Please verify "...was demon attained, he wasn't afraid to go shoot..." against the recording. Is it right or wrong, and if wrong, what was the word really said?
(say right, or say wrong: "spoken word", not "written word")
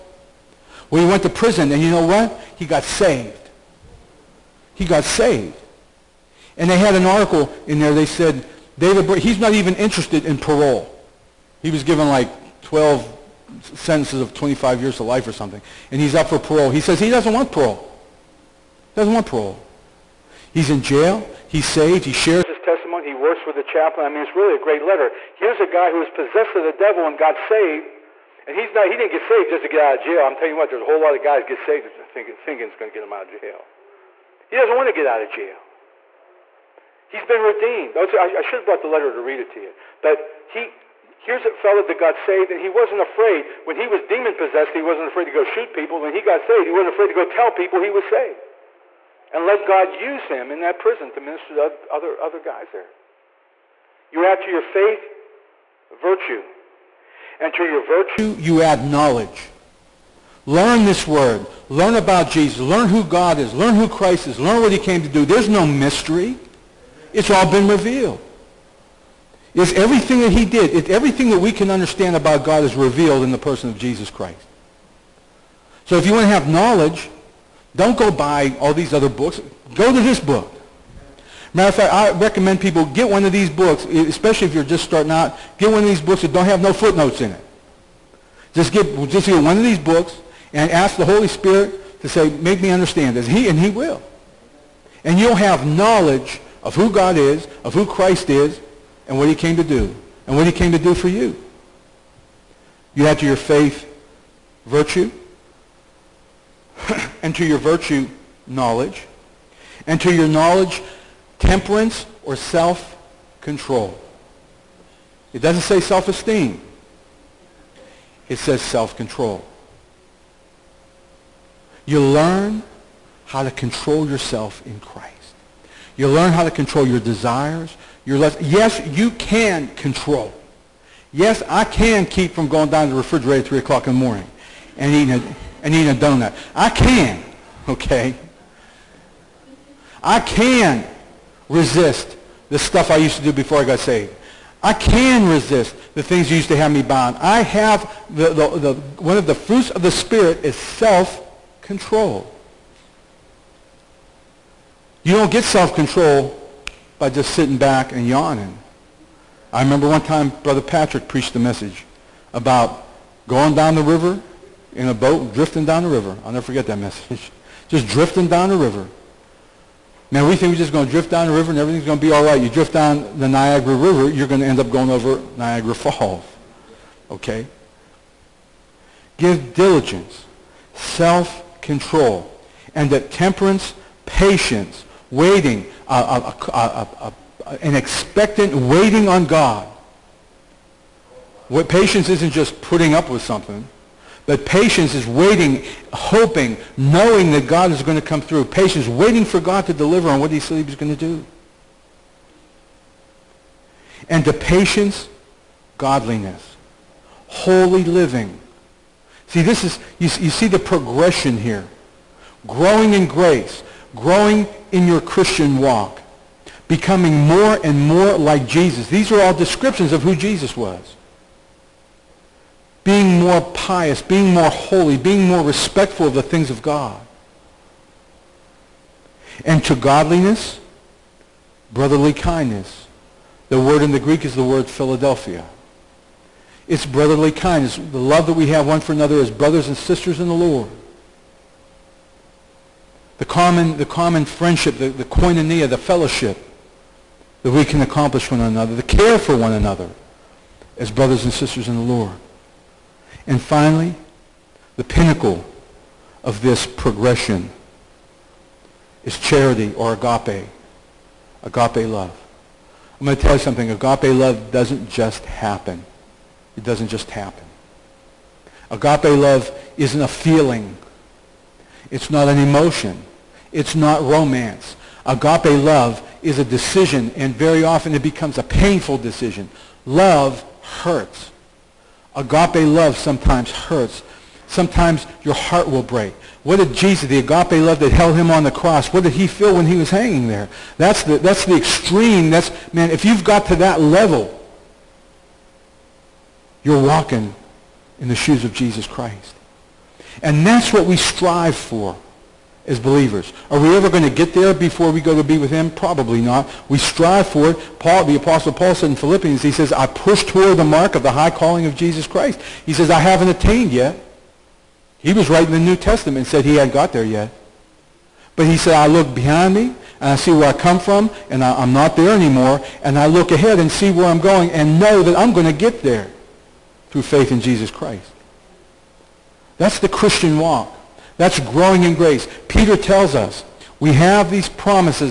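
wrong: "possessed", not "attained".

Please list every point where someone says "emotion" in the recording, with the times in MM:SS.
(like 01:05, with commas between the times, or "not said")
04:32.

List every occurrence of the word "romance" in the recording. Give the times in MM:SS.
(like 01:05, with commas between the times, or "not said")
04:34.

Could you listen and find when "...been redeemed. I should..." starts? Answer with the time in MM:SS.
00:37.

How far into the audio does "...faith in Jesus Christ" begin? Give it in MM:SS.
05:27.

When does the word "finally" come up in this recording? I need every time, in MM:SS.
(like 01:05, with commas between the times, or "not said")
04:13.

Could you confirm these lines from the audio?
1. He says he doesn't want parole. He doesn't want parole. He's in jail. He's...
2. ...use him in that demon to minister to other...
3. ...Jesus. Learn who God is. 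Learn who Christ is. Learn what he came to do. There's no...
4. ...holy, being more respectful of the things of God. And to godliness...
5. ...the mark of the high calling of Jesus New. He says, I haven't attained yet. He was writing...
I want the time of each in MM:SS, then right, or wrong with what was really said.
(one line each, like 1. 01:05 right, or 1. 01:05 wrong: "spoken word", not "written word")
1. 00:16 right
2. 00:49 wrong: "prison", not "demon"
3. 01:02 right
4. 03:44 right
5. 05:10 wrong: "Christ", not "New".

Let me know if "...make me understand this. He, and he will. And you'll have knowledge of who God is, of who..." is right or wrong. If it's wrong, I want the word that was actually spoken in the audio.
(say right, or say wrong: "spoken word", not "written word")
right.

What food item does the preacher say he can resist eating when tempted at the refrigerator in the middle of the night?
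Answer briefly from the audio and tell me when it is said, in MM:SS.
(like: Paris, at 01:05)
donut, at 02:15.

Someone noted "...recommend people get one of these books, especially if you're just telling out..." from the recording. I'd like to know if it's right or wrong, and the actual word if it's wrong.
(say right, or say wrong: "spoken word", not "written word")
wrong: "starting", not "telling".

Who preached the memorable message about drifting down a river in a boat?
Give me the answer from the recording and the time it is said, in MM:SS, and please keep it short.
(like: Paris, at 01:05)
Brother Patrick, at 02:40.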